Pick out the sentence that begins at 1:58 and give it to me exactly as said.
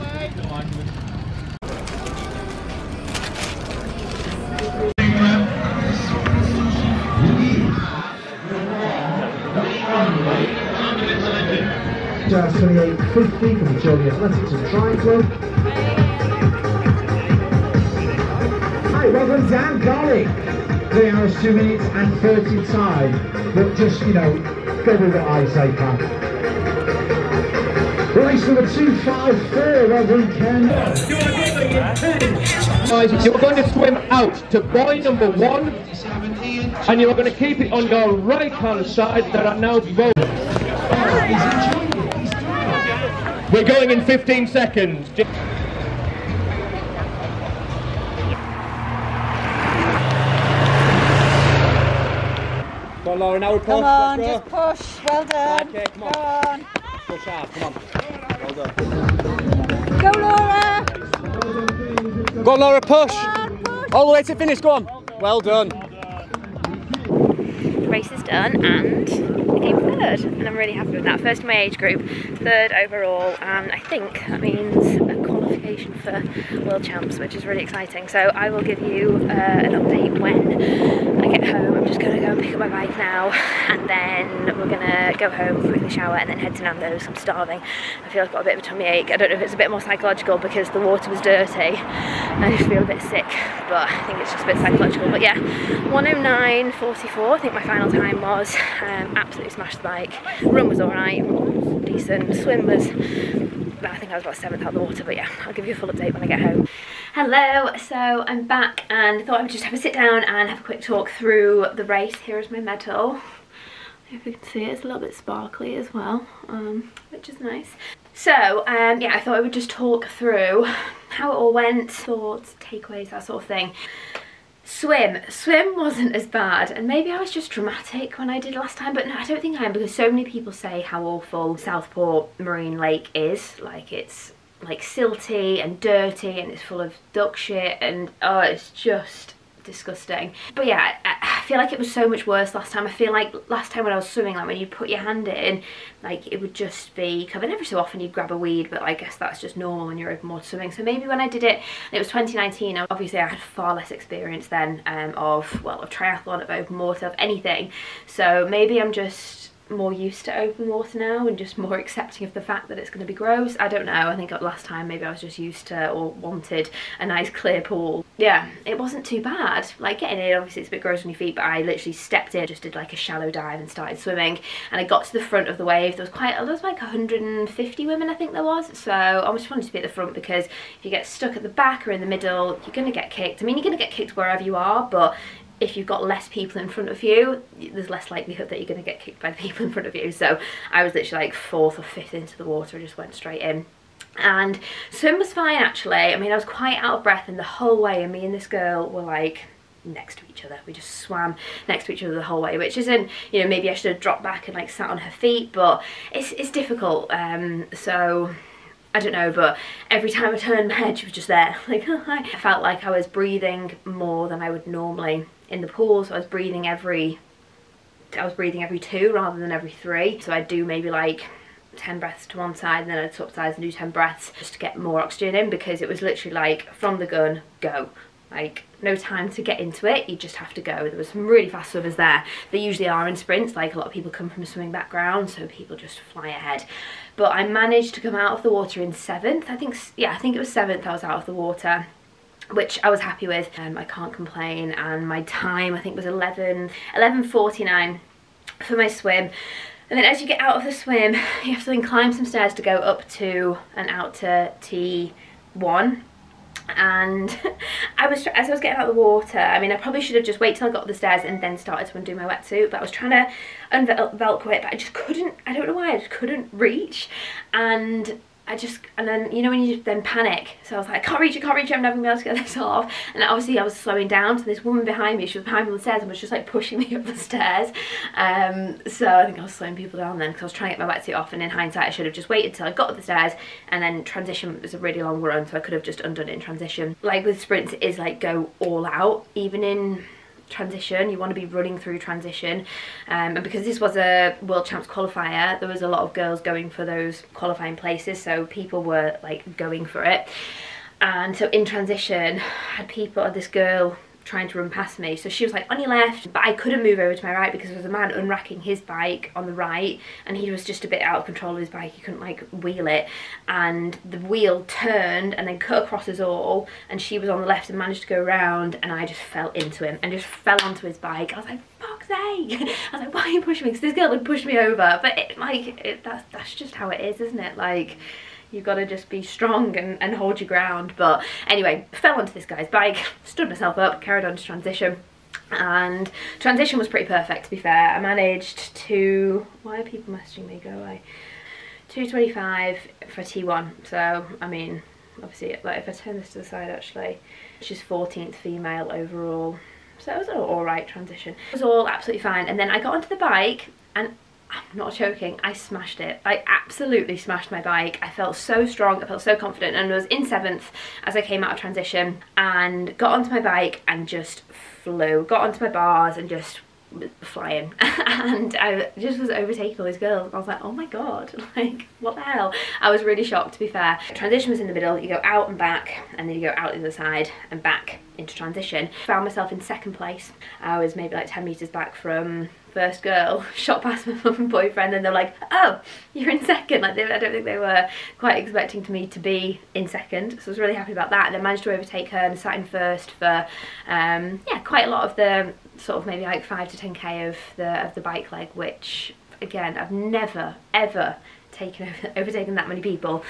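So, um, yeah, I thought I would just talk through how it all went, thoughts, takeaways, that sort of thing.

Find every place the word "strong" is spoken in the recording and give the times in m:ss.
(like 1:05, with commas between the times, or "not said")
5:29, 5:58.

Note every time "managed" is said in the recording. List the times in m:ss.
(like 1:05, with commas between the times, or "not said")
3:57, 5:17, 5:37, 6:31.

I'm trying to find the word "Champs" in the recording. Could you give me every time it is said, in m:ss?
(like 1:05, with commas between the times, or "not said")
1:16, 4:54.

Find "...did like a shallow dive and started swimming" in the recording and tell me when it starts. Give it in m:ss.
2:52.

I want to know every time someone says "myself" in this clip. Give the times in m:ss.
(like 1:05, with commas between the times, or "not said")
5:33, 6:19.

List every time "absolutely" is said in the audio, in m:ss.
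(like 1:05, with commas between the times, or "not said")
1:39, 5:51, 5:56.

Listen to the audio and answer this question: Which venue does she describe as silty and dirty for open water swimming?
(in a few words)
Southport Marine Lake.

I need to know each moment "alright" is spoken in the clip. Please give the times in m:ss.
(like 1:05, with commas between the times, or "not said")
1:40, 5:50.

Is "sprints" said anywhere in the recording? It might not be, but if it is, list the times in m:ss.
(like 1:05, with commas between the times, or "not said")
3:53, 4:47.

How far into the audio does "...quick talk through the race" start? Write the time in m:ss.
1:50.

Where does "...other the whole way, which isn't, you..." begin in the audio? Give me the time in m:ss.
3:22.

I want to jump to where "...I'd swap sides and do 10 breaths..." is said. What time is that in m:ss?
3:43.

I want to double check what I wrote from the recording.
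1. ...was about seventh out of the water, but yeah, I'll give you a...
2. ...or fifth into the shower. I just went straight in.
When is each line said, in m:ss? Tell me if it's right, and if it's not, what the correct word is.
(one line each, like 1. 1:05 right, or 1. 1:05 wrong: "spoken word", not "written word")
1. 1:44 right
2. 3:11 wrong: "water", not "shower".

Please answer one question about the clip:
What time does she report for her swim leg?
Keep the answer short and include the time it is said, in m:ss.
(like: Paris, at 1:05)
11:49, at 4:06.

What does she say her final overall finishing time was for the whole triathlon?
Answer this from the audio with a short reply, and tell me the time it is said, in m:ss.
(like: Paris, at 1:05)
1:09.44, at 1:35.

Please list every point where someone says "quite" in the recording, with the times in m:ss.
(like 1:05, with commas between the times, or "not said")
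2:56, 3:16, 6:28, 6:34.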